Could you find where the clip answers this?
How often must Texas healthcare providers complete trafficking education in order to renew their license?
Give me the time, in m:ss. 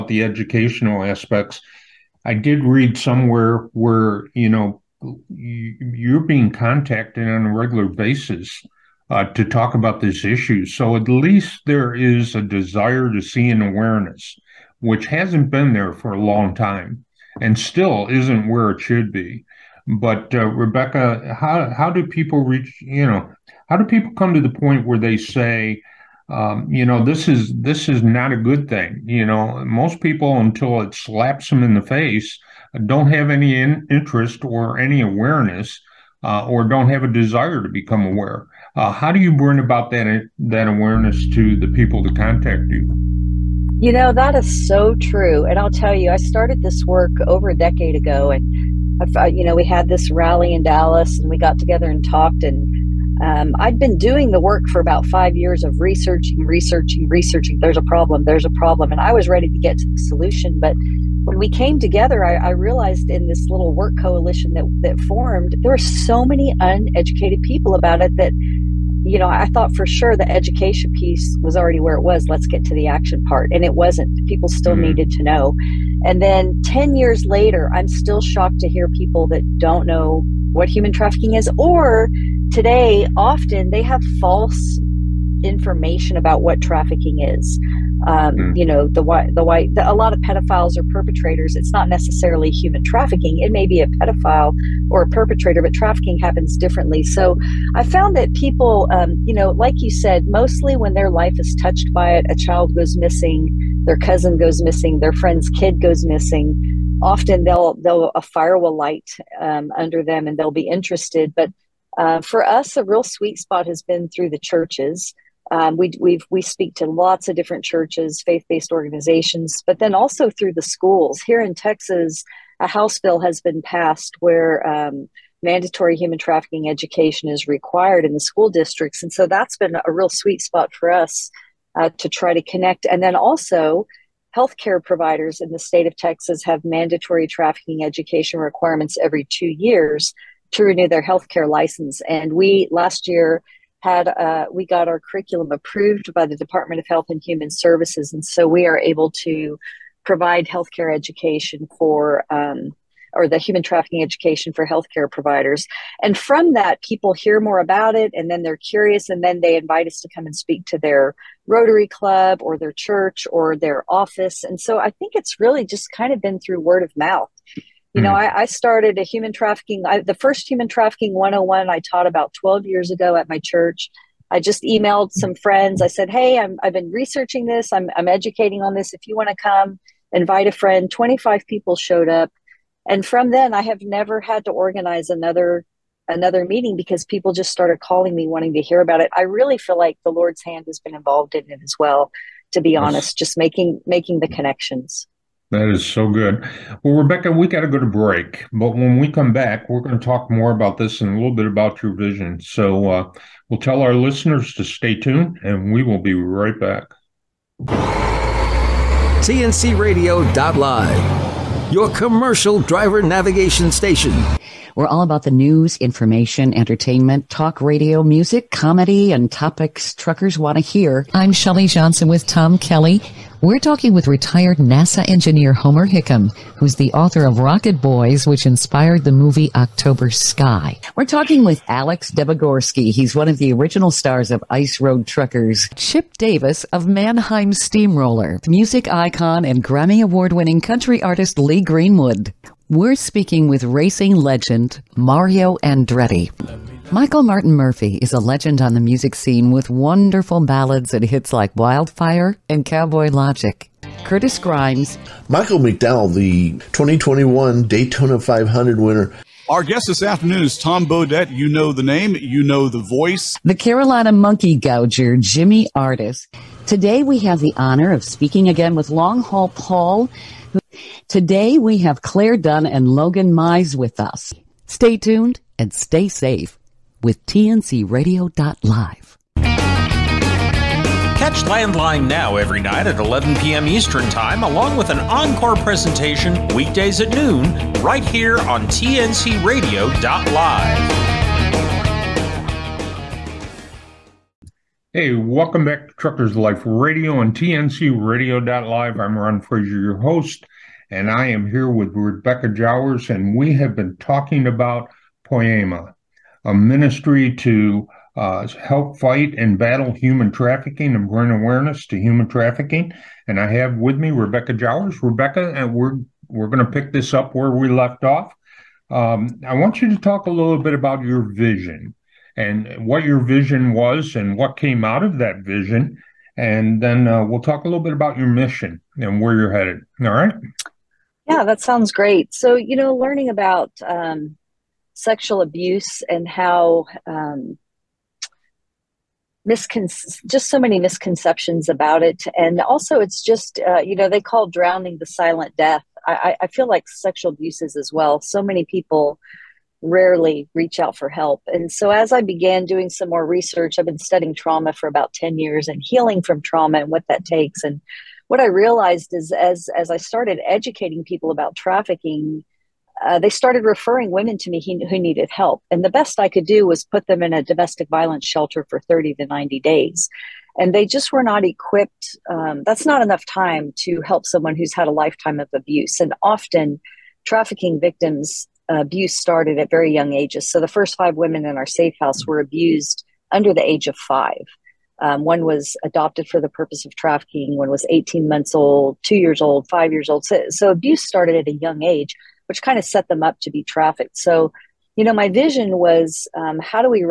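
2:19.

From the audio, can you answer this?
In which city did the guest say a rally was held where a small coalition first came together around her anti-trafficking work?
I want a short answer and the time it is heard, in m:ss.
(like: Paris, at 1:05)
Dallas, at 0:50.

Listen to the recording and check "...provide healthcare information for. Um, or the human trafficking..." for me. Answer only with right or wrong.
wrong.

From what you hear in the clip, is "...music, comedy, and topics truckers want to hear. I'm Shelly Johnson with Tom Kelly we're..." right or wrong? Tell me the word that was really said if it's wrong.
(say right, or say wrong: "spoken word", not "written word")
right.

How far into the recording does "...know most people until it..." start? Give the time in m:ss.
0:29.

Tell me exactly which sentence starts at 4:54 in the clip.
Hey, welcome back to Truckers Life Radio and tncradio.live.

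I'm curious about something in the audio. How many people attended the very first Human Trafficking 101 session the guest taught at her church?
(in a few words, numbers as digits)
25.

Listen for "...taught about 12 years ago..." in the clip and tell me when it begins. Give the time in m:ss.
2:51.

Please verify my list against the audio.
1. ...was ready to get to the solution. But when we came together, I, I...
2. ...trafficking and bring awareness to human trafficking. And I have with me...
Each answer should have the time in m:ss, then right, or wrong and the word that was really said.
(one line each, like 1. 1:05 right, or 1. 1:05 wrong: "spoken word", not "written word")
1. 0:59 right
2. 5:10 right.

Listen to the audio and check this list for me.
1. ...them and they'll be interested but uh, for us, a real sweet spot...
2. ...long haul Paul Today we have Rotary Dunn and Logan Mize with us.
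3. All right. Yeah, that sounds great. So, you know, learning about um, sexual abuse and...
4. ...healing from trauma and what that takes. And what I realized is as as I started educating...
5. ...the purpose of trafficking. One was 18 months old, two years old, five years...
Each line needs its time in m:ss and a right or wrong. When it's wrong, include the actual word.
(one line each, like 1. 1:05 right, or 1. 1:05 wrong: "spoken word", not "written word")
1. 1:50 right
2. 4:28 wrong: "Claire", not "Rotary"
3. 5:30 right
4. 5:55 right
5. 6:26 right.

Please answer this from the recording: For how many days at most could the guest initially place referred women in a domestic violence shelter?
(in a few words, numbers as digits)
90.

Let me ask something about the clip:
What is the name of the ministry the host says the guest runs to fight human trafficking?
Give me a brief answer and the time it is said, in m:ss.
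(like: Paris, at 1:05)
Poema, at 5:05.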